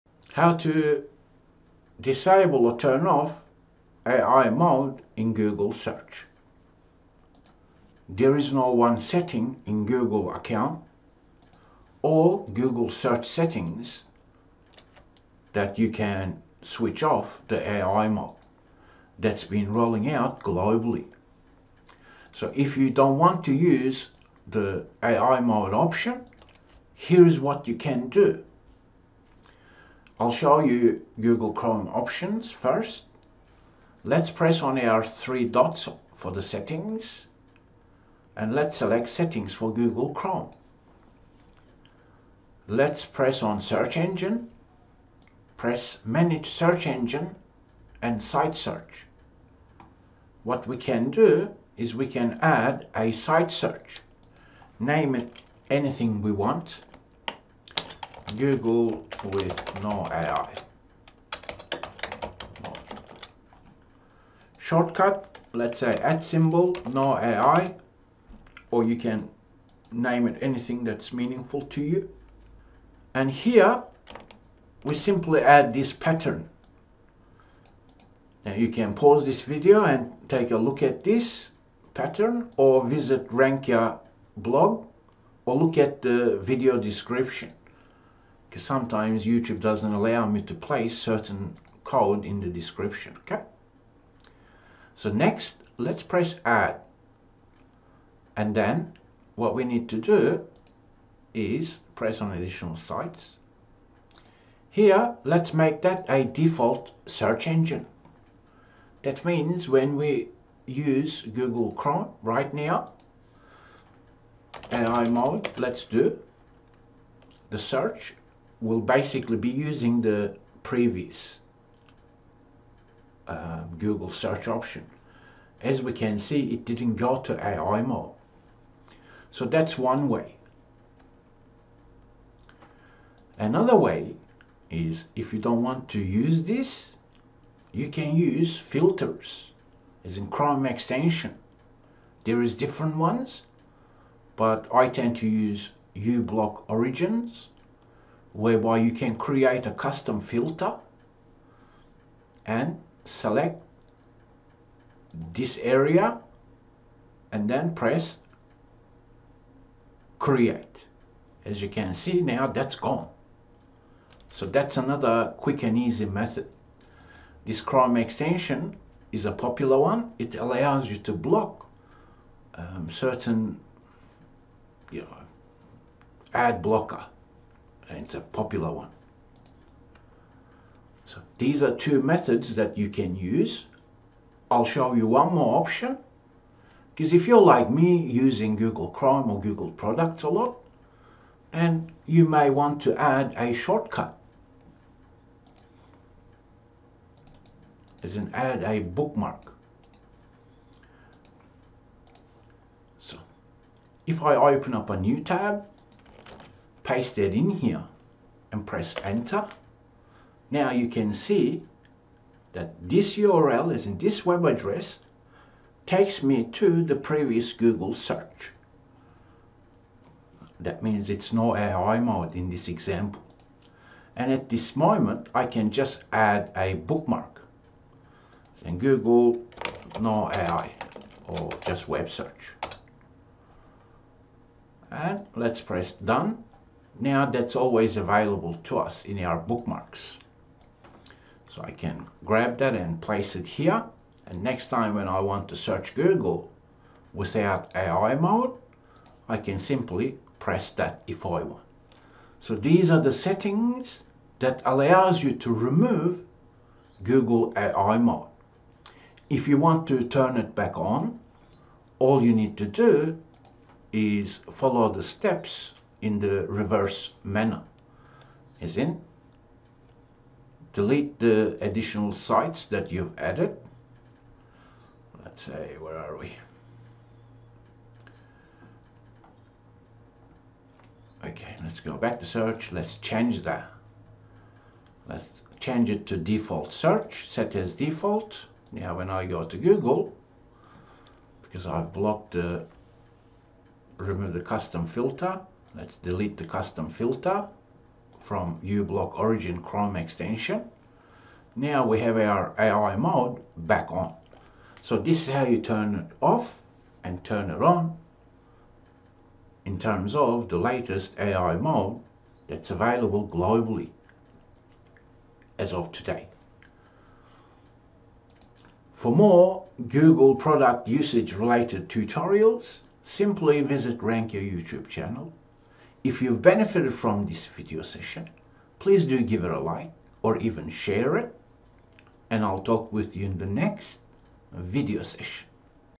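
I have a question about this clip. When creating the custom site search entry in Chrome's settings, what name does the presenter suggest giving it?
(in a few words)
Google with no AI.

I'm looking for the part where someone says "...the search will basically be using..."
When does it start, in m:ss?
1:57.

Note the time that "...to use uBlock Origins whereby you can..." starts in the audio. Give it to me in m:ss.
2:25.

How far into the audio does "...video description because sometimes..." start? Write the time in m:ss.
1:26.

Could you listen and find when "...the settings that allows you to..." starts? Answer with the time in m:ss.
4:13.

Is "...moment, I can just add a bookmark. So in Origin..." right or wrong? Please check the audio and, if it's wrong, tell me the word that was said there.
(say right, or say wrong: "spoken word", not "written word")
wrong: "Google", not "Origin".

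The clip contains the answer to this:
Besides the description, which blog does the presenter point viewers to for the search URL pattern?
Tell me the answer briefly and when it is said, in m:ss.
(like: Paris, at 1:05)
RankYa blog, at 1:23.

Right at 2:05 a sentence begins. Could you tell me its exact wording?
As we can see, it didn't go to AI mode.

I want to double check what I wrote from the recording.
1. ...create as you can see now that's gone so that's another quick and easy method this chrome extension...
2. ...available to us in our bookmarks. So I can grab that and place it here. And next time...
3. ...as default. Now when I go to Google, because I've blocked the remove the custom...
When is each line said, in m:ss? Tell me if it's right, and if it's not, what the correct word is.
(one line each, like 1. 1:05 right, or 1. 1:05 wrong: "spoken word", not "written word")
1. 2:40 right
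2. 3:57 right
3. 4:47 right.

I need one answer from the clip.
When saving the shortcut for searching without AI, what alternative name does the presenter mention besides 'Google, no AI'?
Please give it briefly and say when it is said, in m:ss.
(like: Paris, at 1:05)
web search, at 3:51.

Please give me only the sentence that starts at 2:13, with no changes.
Another way is if you don't want to use this, you can use filters as in Chrome extension.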